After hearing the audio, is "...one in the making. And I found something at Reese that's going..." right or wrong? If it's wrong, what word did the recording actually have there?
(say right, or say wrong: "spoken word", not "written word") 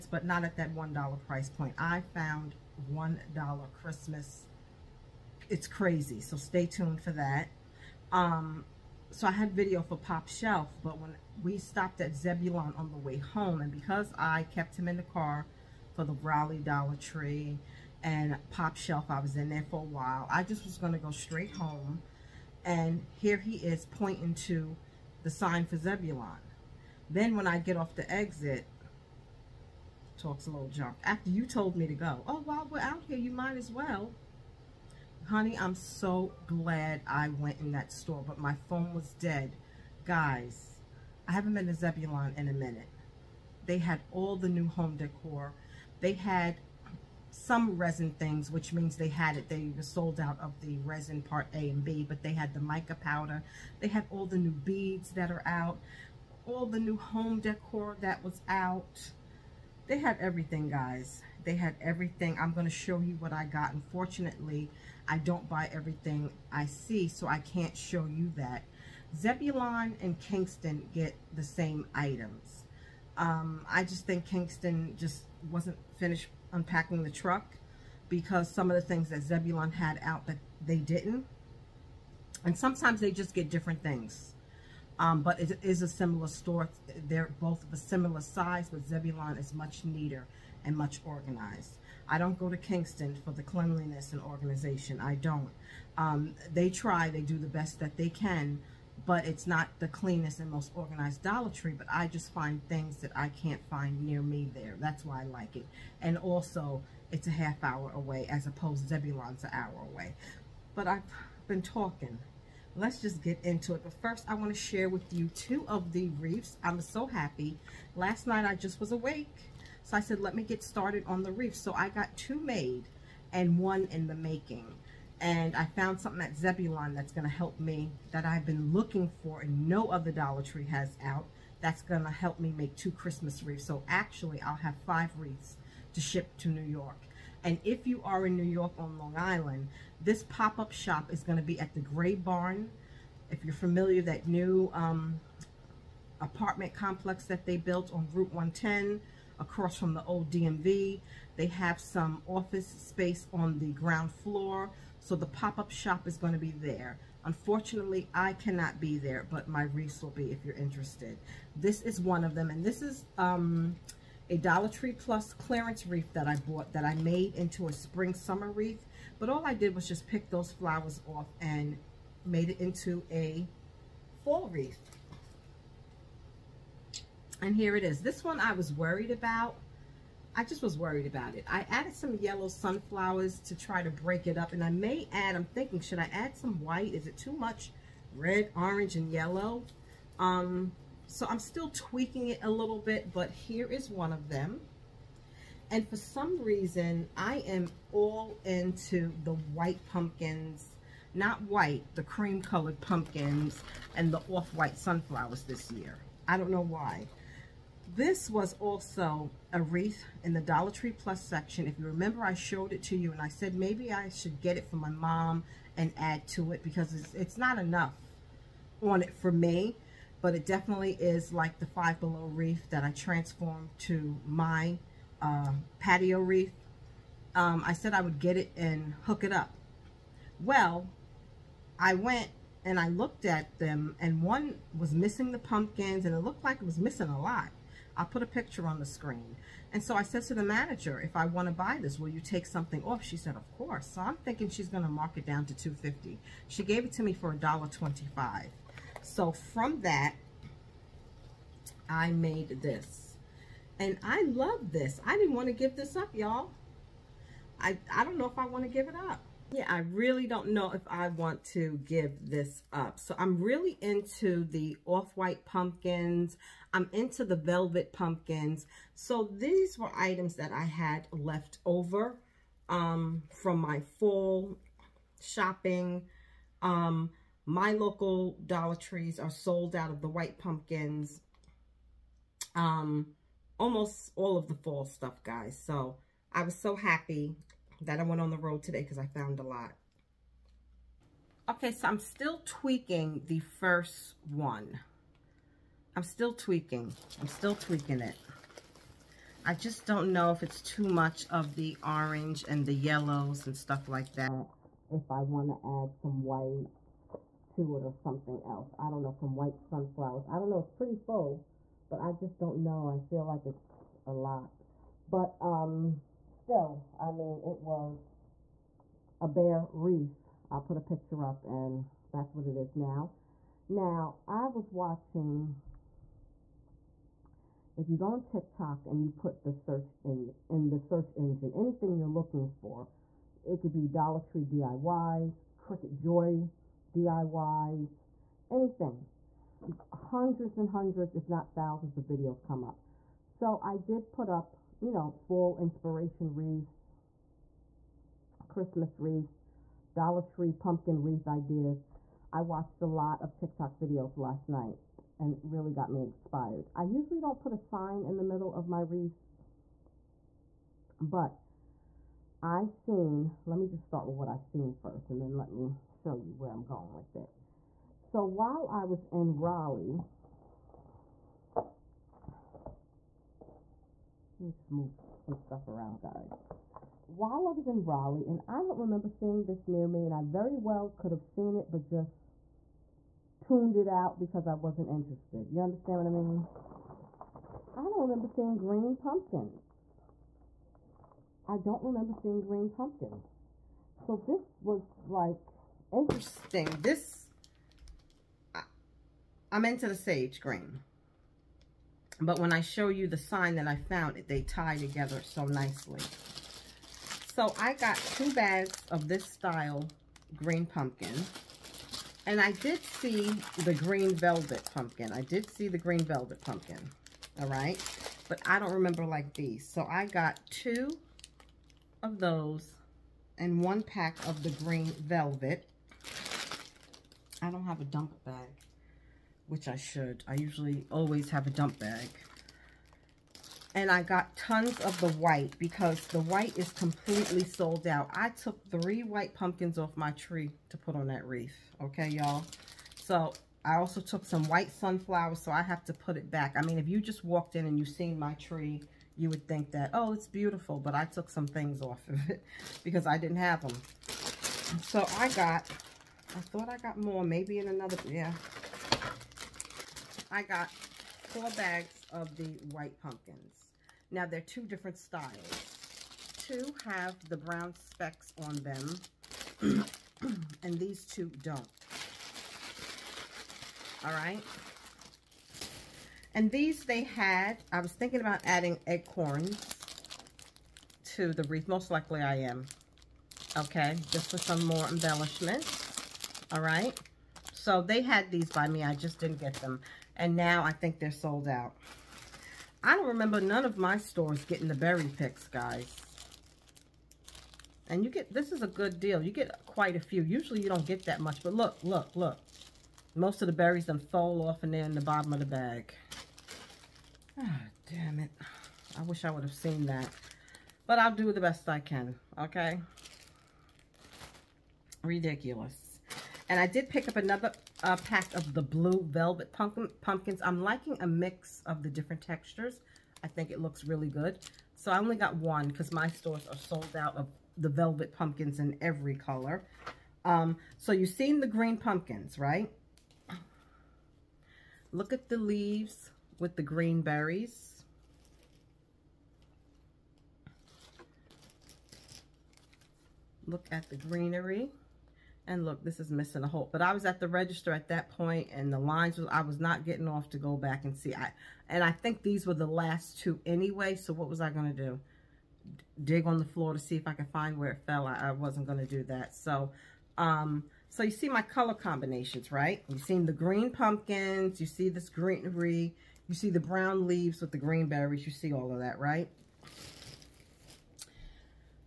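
wrong: "Zebulon", not "Reese".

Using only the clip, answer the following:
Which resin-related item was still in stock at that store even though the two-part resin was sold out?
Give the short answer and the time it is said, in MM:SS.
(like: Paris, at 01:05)
mica powder, at 00:52.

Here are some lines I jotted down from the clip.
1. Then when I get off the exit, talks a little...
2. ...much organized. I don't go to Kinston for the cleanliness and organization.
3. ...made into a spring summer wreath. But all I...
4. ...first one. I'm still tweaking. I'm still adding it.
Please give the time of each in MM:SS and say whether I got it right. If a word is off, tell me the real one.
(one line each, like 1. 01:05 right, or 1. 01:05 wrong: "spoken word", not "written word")
1. 00:27 right
2. 01:30 right
3. 02:46 right
4. 04:53 wrong: "tweaking", not "adding".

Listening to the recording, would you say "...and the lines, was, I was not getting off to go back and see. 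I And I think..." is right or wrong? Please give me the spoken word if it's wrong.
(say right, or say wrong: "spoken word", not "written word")
right.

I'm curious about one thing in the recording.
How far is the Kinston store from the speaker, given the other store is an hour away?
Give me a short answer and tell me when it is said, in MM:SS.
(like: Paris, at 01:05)
a half hour, at 01:47.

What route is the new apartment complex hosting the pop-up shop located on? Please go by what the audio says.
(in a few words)
Route 110.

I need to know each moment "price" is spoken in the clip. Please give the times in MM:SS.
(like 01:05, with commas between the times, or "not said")
00:01.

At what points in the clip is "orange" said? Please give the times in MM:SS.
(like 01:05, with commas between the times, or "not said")
03:08, 05:01.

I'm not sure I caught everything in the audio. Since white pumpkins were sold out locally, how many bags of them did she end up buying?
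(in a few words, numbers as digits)
4.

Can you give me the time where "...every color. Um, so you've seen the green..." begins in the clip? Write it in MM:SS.
08:48.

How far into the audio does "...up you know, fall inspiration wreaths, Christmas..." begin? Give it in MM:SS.
05:44.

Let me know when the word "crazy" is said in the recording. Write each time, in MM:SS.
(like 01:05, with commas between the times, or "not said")
00:05.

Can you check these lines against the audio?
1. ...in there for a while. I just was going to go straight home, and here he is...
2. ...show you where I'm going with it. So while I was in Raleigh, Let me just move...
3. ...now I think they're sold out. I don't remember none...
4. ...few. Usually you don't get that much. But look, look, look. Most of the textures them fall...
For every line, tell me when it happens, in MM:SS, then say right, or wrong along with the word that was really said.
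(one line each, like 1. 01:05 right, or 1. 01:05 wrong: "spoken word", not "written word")
1. 00:19 right
2. 06:05 right
3. 08:10 right
4. 08:20 wrong: "berries", not "textures".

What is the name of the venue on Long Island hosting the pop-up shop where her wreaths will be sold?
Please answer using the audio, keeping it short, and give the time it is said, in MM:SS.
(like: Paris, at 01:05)
the Gray Barn, at 02:21.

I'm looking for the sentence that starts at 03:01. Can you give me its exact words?
I added some yellow sunflowers to try to break it up.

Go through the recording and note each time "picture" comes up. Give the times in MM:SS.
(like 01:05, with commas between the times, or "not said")
03:58, 05:20.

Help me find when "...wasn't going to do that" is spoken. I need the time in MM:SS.
09:18.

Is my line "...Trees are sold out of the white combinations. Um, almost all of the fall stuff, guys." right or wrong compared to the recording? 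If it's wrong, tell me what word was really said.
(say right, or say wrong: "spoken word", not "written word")
wrong: "pumpkins", not "combinations".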